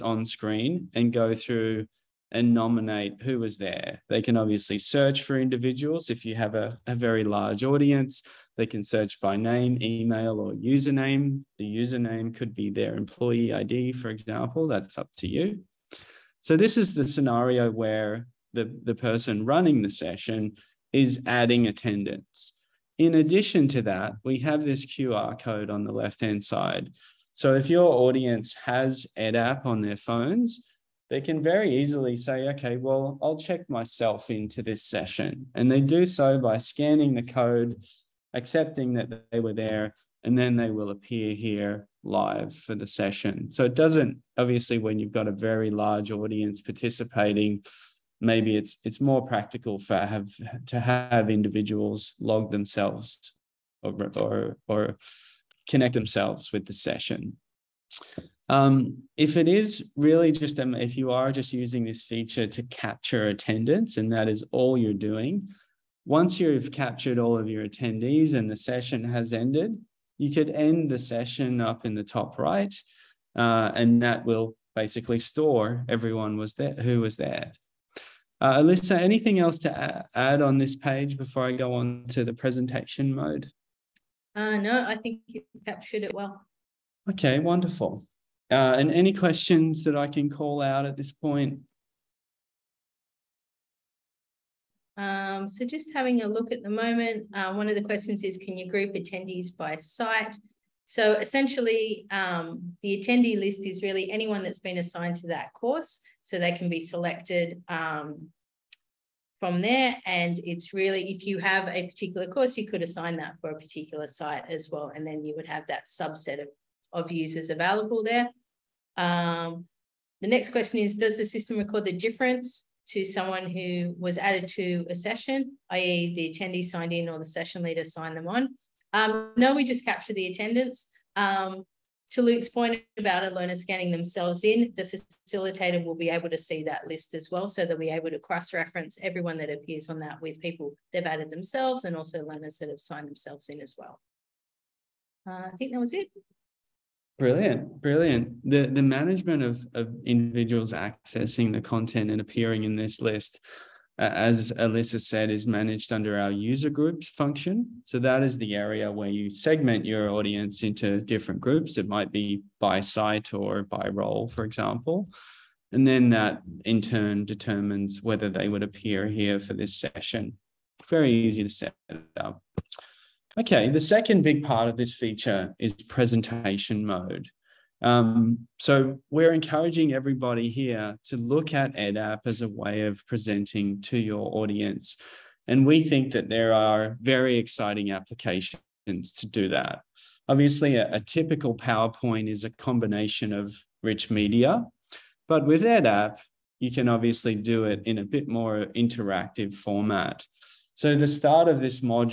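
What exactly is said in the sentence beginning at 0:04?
They can obviously search for individuals if you have a, a, very large audience.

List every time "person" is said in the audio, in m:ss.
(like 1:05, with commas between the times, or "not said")
0:18.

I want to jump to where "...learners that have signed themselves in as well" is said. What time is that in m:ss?
2:22.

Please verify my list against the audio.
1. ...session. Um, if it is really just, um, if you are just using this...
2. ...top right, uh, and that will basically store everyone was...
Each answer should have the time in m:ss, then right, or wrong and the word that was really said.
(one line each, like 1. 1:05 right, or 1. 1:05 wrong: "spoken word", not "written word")
1. 0:56 right
2. 1:12 right.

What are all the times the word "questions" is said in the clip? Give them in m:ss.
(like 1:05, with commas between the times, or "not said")
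1:29, 1:37, 2:00.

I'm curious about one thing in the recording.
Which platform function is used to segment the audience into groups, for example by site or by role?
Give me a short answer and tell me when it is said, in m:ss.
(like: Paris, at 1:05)
User groups, at 2:36.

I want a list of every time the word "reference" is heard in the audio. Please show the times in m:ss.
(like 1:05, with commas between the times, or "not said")
2:18.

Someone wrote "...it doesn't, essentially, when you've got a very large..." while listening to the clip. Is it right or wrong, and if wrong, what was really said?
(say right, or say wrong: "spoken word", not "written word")
wrong: "obviously", not "essentially".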